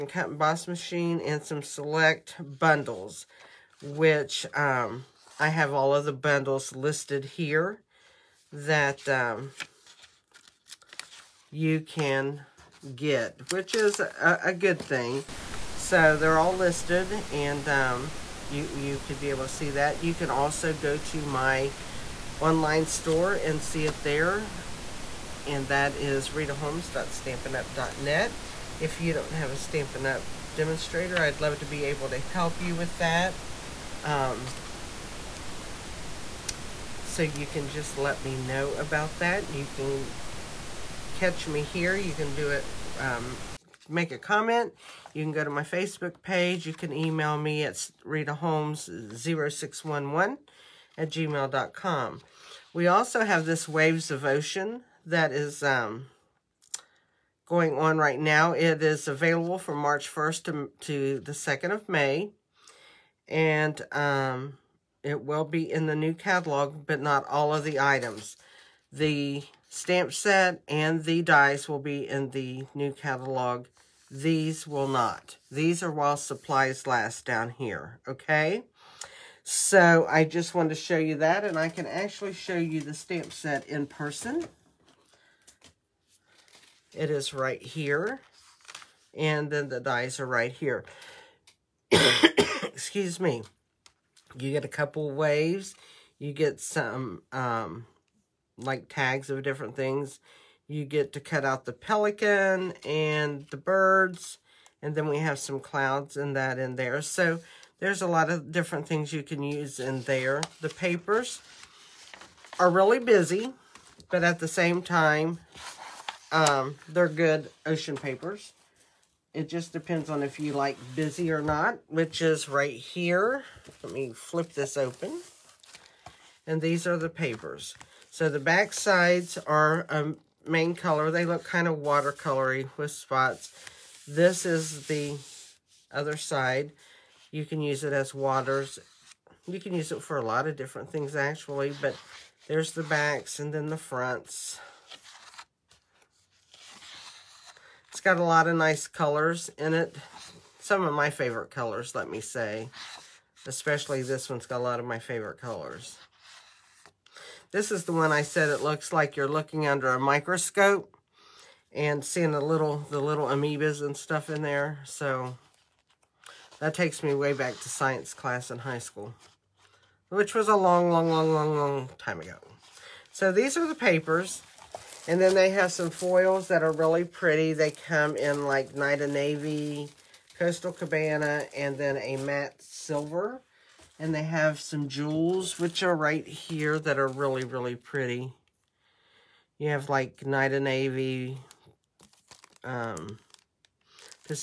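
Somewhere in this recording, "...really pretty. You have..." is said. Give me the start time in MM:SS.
03:07.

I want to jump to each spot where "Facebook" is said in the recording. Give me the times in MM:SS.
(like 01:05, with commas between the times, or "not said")
00:45.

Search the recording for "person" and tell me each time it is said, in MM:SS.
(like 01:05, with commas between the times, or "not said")
01:23.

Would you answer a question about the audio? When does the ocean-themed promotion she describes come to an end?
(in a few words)
May 2.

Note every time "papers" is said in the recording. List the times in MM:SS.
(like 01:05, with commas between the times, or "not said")
01:50, 01:57, 02:07, 02:53.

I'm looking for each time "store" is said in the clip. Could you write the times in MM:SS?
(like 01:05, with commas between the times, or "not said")
00:22.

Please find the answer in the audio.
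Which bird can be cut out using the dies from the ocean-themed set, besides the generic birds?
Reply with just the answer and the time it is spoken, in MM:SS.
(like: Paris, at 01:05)
pelican, at 01:41.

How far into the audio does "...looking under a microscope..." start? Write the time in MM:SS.
02:39.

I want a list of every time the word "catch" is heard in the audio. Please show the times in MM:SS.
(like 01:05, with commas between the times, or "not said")
00:41.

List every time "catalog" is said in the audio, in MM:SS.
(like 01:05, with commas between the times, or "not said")
01:06, 01:12.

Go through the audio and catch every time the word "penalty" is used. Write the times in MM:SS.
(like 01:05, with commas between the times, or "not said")
not said.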